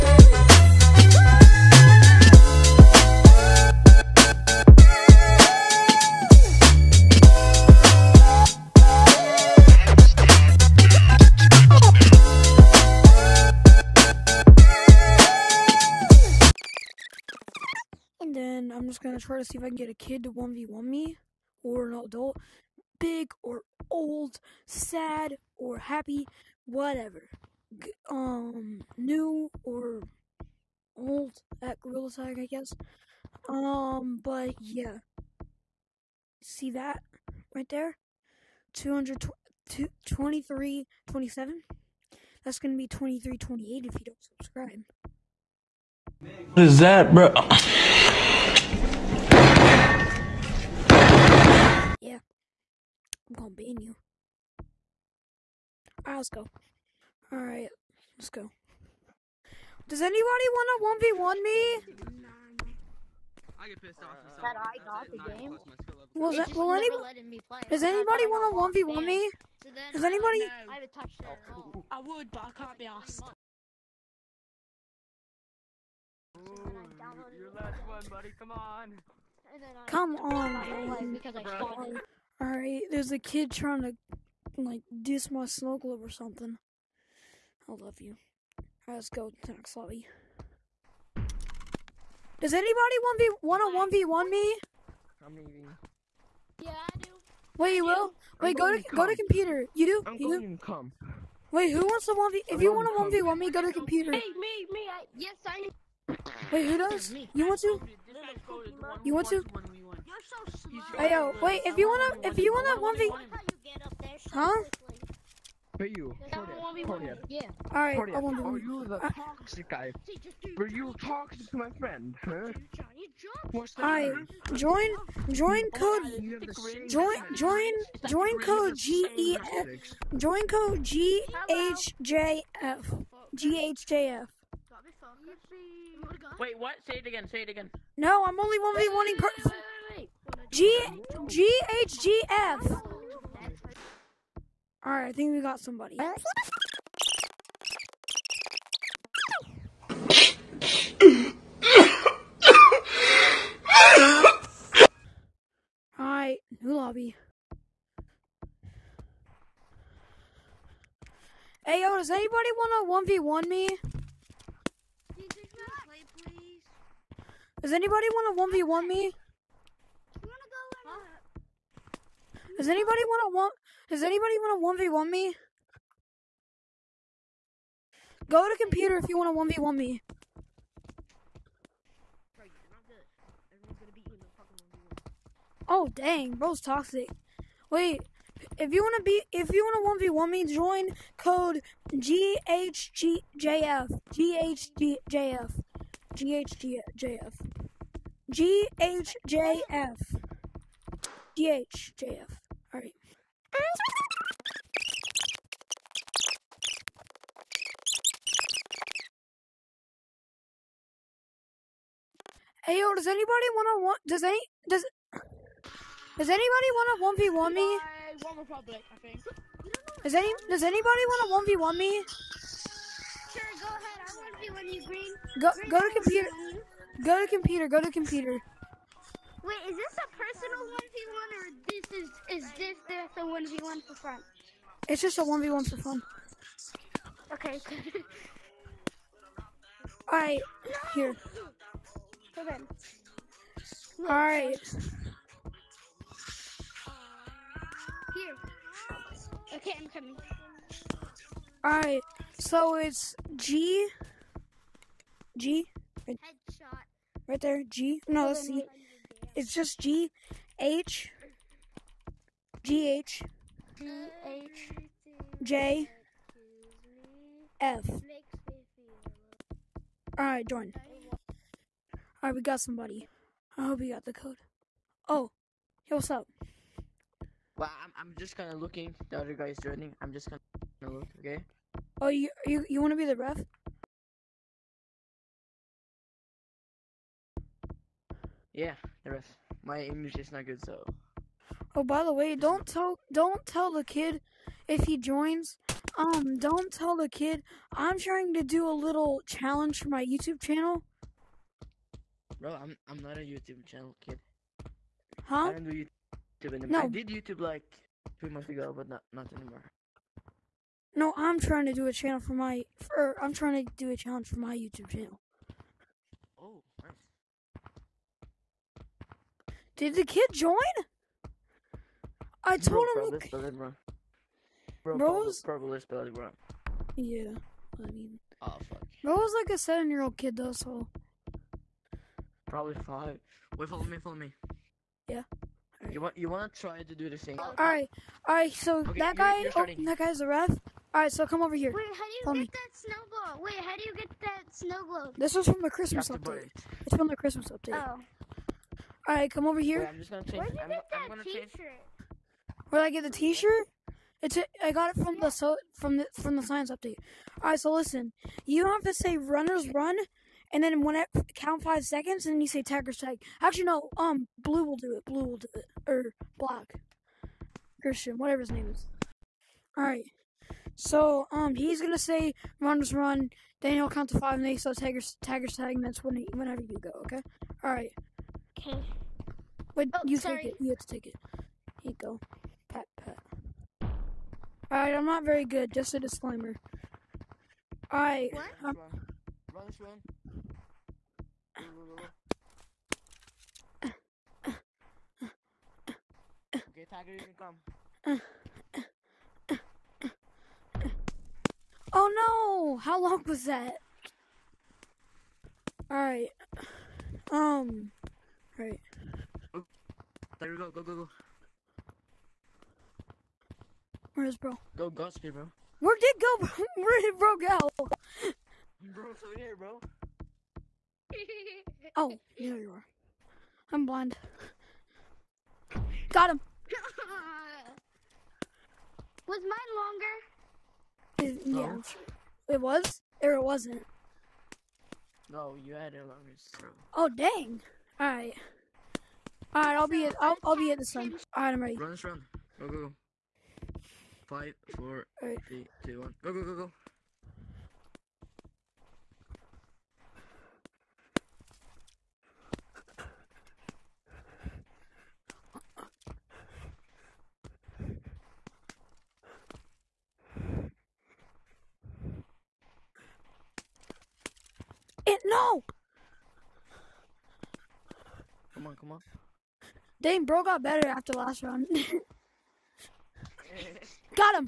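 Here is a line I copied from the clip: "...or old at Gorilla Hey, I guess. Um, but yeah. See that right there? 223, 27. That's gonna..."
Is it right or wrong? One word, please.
wrong.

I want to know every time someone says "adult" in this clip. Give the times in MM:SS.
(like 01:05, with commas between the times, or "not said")
00:22.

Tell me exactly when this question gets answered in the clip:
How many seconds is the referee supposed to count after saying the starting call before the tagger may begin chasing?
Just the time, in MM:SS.
06:01.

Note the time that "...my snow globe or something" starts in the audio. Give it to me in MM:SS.
01:25.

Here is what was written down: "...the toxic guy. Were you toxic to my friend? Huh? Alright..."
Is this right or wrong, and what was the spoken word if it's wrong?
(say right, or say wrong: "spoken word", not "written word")
right.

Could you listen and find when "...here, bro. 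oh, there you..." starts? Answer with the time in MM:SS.
06:59.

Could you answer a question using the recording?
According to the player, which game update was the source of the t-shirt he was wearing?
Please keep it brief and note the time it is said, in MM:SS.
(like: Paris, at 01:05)
science update, at 05:56.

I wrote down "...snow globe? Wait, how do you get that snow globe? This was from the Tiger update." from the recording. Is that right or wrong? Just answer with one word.
wrong.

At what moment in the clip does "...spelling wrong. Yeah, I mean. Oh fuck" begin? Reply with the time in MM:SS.
05:25.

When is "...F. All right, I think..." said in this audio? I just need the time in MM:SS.
02:22.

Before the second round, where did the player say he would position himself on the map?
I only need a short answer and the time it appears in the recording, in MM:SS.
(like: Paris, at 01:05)
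the sun, at 07:20.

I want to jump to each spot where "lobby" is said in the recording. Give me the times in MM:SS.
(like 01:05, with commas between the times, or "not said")
01:29, 02:36.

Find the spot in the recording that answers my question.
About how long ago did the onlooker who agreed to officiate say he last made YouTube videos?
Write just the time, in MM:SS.
05:08.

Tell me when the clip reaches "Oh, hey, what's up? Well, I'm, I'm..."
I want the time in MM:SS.
04:35.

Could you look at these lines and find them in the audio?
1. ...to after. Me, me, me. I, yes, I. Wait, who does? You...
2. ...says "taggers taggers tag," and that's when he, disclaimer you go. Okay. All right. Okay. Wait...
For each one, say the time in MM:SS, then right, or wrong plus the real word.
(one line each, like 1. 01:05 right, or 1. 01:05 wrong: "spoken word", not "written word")
1. 01:43 wrong: "computer", not "after"
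2. 06:14 wrong: "whenever", not "disclaimer".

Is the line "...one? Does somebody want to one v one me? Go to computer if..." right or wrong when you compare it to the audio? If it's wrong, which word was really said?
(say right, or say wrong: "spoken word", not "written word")
wrong: "anybody", not "somebody".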